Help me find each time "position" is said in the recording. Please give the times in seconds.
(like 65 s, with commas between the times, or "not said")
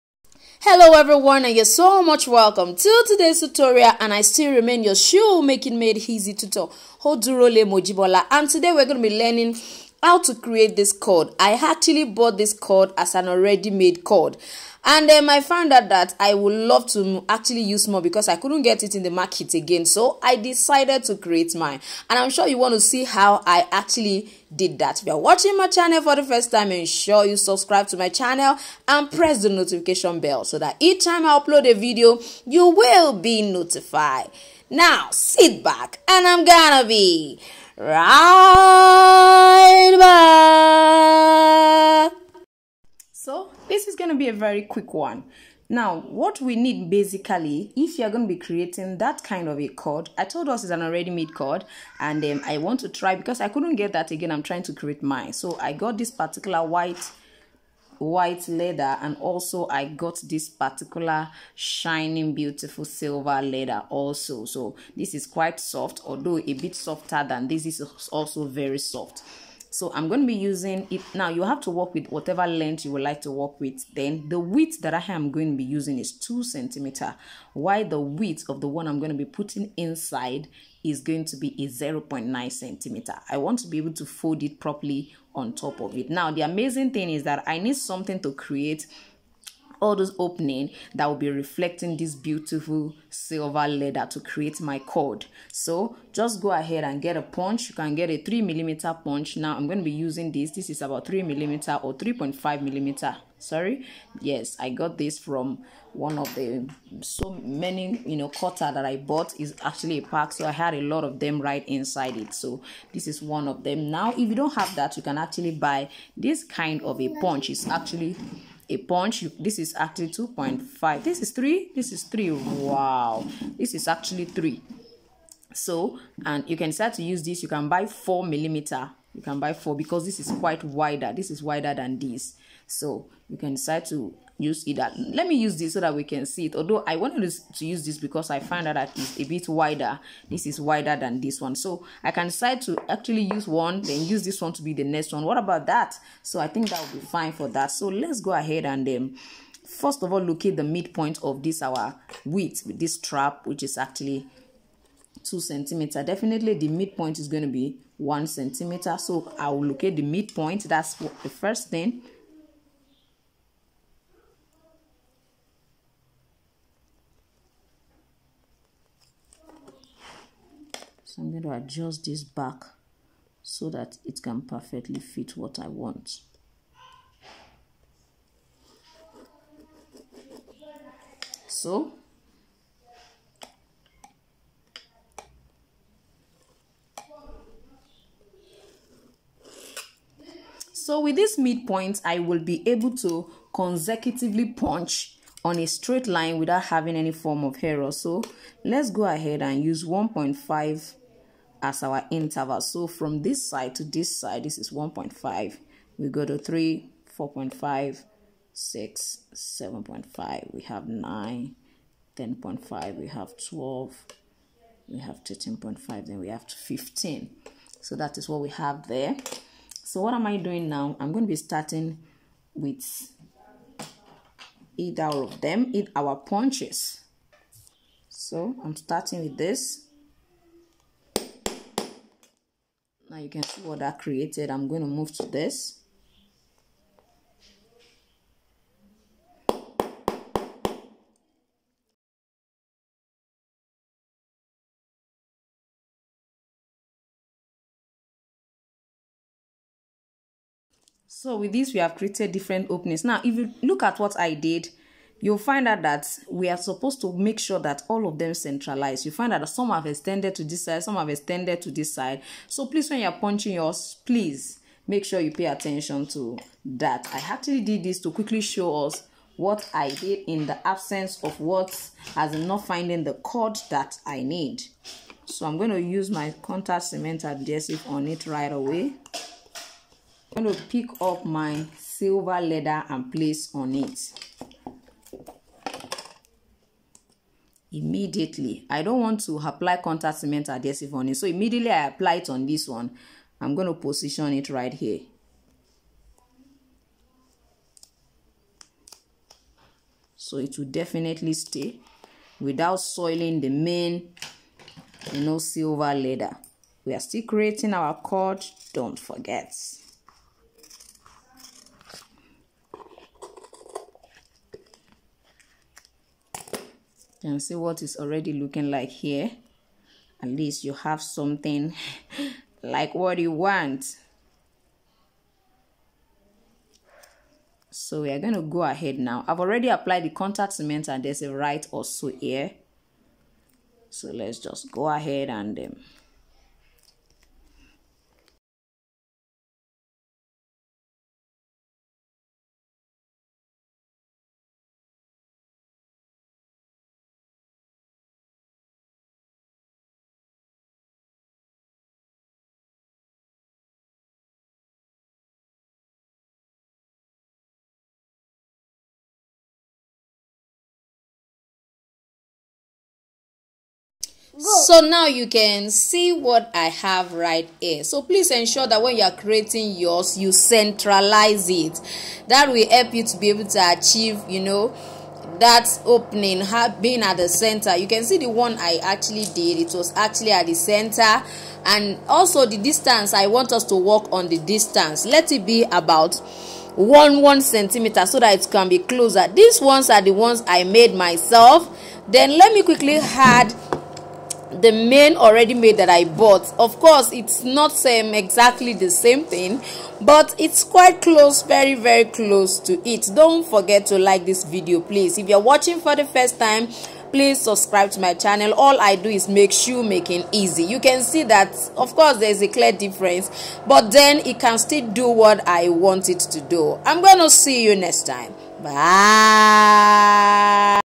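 293 s.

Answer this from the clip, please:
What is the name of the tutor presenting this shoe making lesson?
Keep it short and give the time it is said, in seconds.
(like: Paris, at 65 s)
Hodurole Mojibola, at 7 s.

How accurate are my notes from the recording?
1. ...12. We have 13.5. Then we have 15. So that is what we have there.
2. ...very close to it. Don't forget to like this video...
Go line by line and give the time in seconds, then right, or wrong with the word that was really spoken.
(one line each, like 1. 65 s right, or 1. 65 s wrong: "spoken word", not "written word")
1. 213 s right
2. 401 s right.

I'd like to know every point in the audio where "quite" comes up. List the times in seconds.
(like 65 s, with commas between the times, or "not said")
65 s, 130 s, 400 s.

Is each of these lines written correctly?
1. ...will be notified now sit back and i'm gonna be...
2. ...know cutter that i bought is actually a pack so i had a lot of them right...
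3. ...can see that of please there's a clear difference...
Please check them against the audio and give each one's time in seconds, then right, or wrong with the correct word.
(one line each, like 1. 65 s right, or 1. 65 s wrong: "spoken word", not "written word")
1. 32 s right
2. 108 s right
3. 410 s wrong: "course", not "please".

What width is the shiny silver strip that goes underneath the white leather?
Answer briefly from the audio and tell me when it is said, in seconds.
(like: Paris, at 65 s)
0.9 centimeter, at 81 s.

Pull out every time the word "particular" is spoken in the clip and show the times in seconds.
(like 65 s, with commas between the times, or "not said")
56 s, 60 s.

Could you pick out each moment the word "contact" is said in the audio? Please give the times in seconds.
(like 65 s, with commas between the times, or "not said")
276 s, 289 s, 330 s.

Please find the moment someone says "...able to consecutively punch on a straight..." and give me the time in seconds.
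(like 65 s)
192 s.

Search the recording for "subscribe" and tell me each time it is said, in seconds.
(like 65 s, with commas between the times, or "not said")
27 s, 407 s.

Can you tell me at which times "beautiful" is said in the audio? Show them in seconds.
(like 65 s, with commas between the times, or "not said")
62 s, 92 s.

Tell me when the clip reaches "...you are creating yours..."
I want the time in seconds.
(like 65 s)
368 s.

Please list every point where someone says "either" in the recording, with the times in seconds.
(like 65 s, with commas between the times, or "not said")
134 s, 224 s.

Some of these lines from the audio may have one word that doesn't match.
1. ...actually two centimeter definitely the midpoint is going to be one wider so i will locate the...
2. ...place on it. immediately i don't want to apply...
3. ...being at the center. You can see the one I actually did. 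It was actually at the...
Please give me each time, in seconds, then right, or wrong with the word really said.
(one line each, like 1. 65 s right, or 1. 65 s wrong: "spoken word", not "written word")
1. 153 s wrong: "centimeter", not "wider"
2. 283 s right
3. 376 s right.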